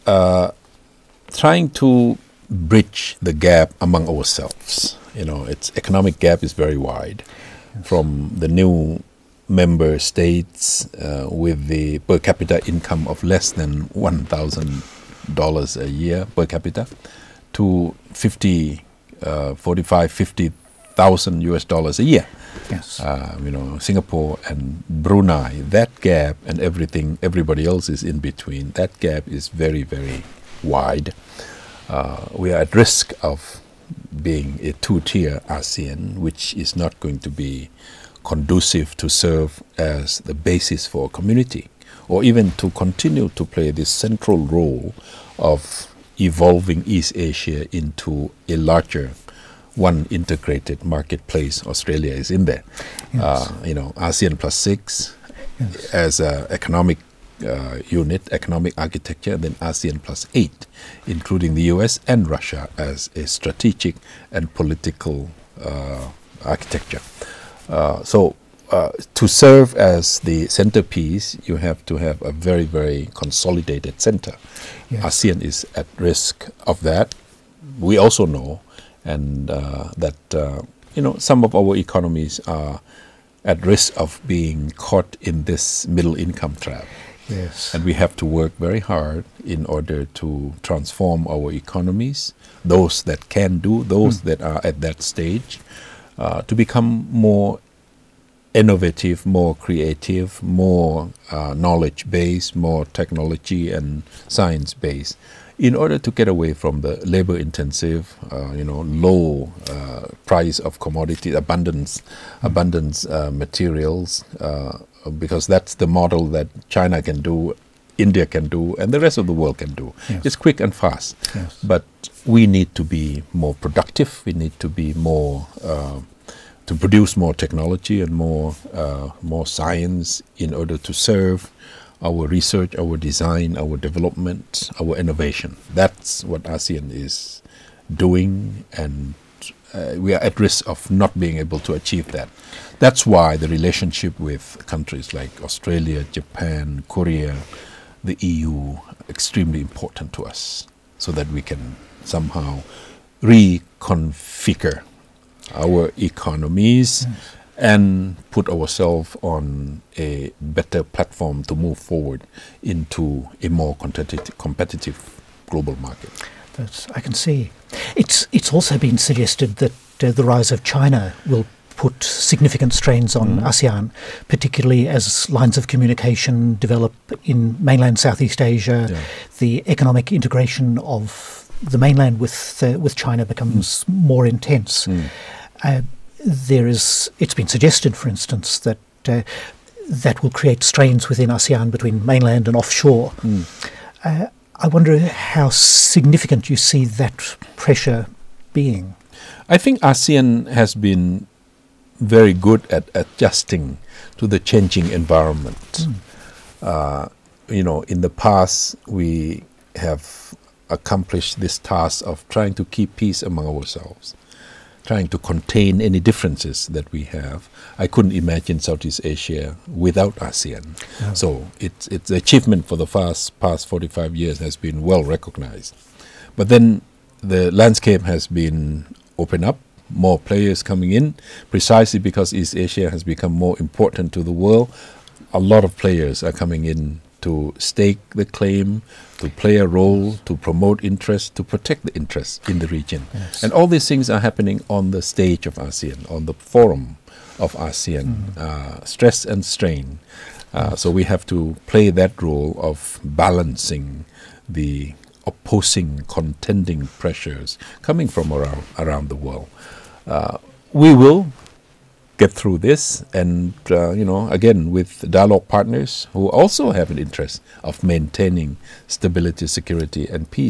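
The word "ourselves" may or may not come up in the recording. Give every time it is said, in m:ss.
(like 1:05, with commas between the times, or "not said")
0:04, 2:38, 3:33.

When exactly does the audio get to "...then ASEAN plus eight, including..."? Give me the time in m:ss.
0:59.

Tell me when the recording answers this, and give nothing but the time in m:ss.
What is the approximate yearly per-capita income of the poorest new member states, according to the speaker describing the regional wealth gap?
0:13.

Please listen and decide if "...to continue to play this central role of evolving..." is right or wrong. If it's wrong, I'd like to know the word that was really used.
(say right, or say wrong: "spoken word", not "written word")
right.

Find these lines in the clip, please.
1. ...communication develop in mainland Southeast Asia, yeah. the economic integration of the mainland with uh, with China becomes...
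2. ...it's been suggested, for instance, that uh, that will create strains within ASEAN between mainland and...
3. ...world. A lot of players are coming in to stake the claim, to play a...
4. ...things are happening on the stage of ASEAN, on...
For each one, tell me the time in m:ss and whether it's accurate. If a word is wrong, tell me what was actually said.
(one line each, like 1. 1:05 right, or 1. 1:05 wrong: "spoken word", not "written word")
1. 2:55 right
2. 3:07 right
3. 3:54 right
4. 4:03 right.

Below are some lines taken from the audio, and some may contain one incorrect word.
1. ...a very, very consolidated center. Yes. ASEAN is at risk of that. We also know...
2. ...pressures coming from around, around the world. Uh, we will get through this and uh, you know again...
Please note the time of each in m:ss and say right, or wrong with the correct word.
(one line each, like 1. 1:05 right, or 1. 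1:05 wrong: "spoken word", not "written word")
1. 1:12 right
2. 4:17 right.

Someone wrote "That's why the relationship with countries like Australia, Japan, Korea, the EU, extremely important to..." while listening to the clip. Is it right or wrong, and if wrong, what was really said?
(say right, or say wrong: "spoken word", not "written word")
right.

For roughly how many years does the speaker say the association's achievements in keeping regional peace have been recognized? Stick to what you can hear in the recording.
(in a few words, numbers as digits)
45 years.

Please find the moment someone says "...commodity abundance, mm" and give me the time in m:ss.
1:50.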